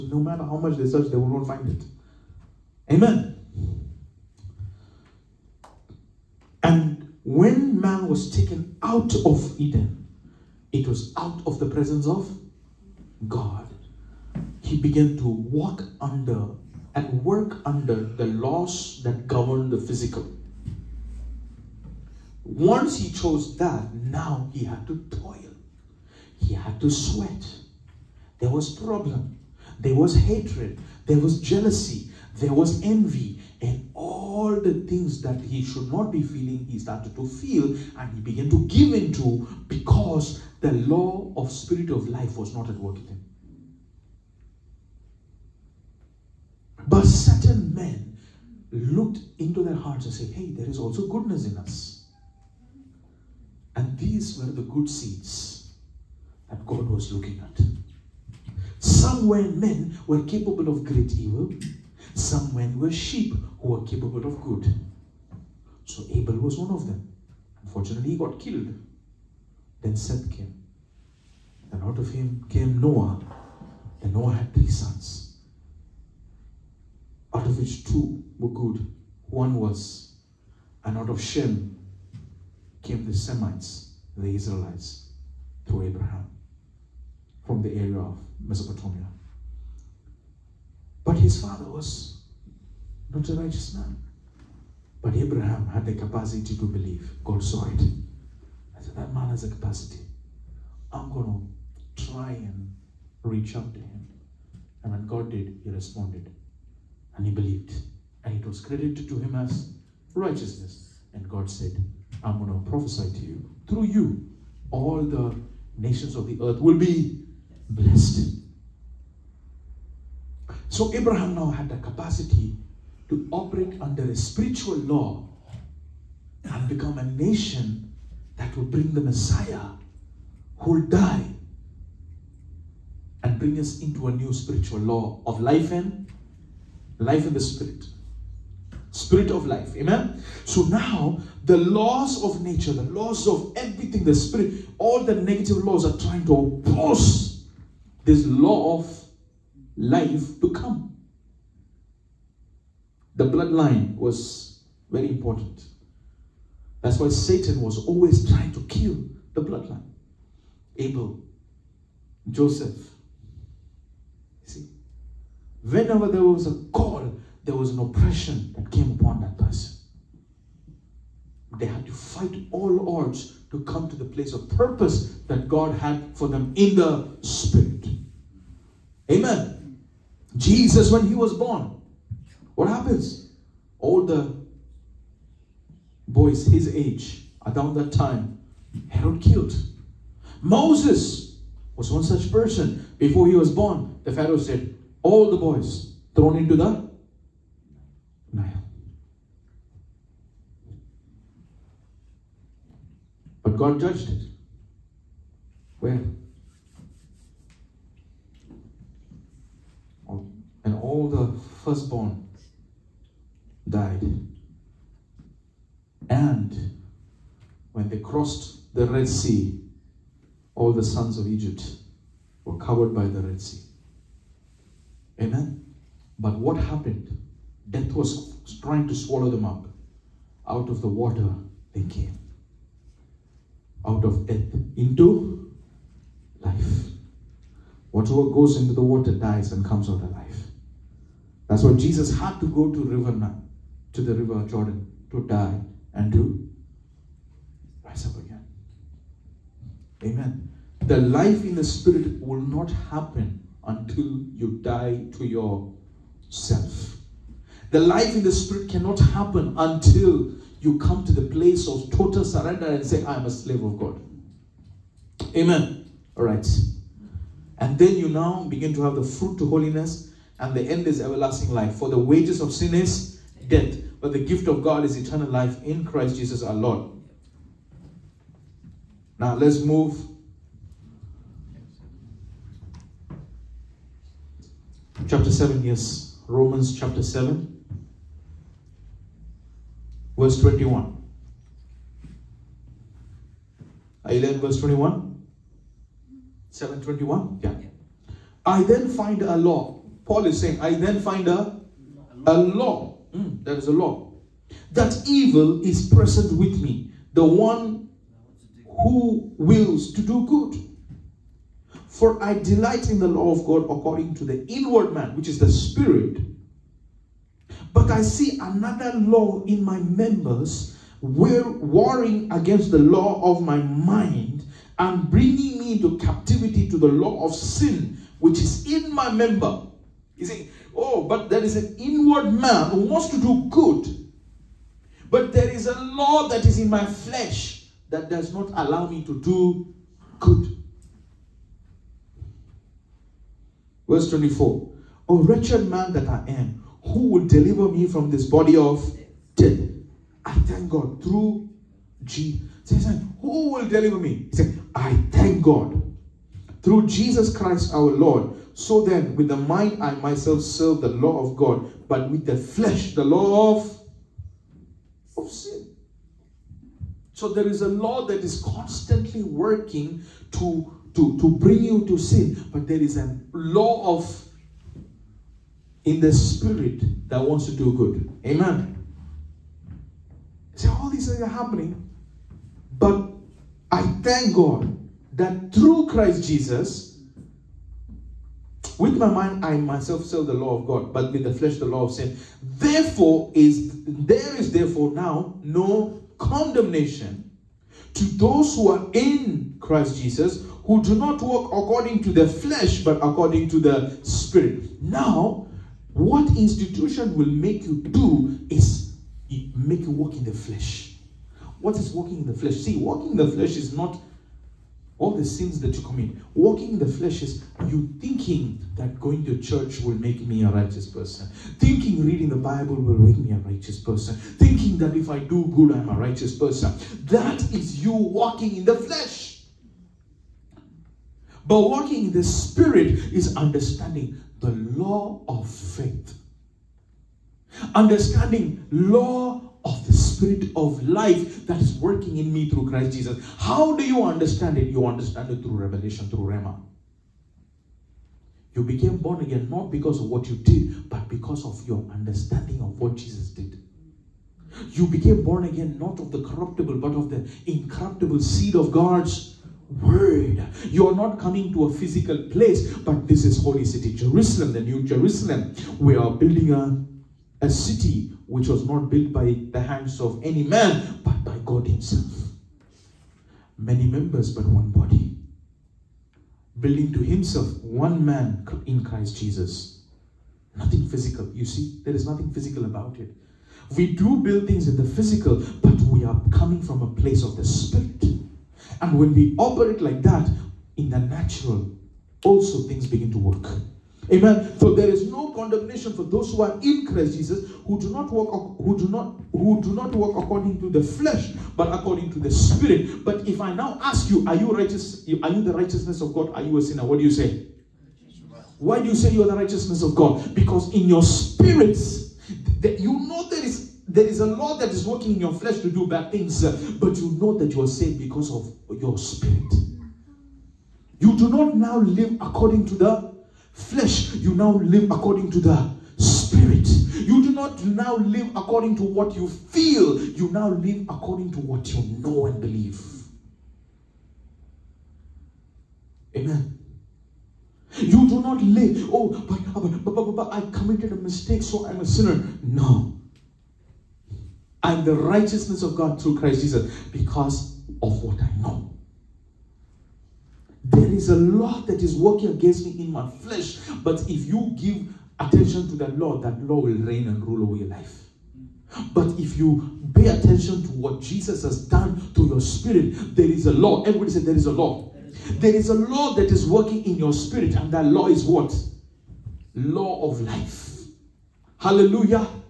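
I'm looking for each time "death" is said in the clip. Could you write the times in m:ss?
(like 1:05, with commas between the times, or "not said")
3:47, 3:54, 4:33, 5:49.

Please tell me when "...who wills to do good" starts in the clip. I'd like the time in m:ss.
5:08.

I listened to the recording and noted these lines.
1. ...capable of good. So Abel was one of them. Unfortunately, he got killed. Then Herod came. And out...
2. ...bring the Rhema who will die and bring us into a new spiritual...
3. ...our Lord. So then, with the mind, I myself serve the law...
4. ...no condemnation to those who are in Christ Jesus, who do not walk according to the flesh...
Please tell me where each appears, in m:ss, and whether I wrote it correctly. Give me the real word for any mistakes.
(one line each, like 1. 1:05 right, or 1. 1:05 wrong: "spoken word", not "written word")
1. 1:03 wrong: "Seth", not "Herod"
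2. 2:08 wrong: "Messiah", not "Rhema"
3. 5:57 right
4. 6:35 right.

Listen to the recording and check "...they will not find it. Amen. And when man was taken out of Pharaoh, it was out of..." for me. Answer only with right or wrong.
wrong.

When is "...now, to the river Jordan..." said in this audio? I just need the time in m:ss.
4:03.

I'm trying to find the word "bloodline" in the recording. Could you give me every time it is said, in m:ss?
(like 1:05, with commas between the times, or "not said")
2:33, 2:39.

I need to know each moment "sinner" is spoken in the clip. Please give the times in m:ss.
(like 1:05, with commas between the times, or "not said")
8:26, 9:01.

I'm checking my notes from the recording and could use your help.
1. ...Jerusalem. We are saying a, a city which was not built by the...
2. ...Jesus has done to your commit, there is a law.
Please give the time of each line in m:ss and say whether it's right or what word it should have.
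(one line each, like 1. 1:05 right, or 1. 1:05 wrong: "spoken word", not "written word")
1. 7:44 wrong: "building", not "saying"
2. 9:21 wrong: "spirit", not "commit".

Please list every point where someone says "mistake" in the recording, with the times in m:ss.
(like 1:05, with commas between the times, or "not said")
9:00.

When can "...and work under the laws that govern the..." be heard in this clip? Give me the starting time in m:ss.
0:16.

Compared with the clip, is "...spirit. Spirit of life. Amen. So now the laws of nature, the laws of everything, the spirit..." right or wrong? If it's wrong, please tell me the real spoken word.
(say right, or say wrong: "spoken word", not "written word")
right.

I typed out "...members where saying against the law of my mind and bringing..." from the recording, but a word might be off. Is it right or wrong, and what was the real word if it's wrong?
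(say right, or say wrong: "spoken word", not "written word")
wrong: "warring", not "saying".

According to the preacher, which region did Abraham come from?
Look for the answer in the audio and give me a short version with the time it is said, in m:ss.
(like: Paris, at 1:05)
Mesopotamia, at 1:28.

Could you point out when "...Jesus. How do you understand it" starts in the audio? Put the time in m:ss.
7:22.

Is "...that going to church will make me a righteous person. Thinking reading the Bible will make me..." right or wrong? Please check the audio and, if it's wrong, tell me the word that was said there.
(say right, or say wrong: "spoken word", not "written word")
right.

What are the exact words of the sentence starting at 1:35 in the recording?
But Abraham had the capacity to believe.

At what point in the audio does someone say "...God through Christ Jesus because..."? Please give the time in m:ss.
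9:05.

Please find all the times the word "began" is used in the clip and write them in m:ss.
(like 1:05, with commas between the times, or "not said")
0:14, 0:38.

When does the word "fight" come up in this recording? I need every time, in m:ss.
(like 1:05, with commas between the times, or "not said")
2:51.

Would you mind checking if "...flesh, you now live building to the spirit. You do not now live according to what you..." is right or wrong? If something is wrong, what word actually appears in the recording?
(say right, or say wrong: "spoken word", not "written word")
wrong: "according", not "building".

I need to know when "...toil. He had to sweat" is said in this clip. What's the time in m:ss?
0:25.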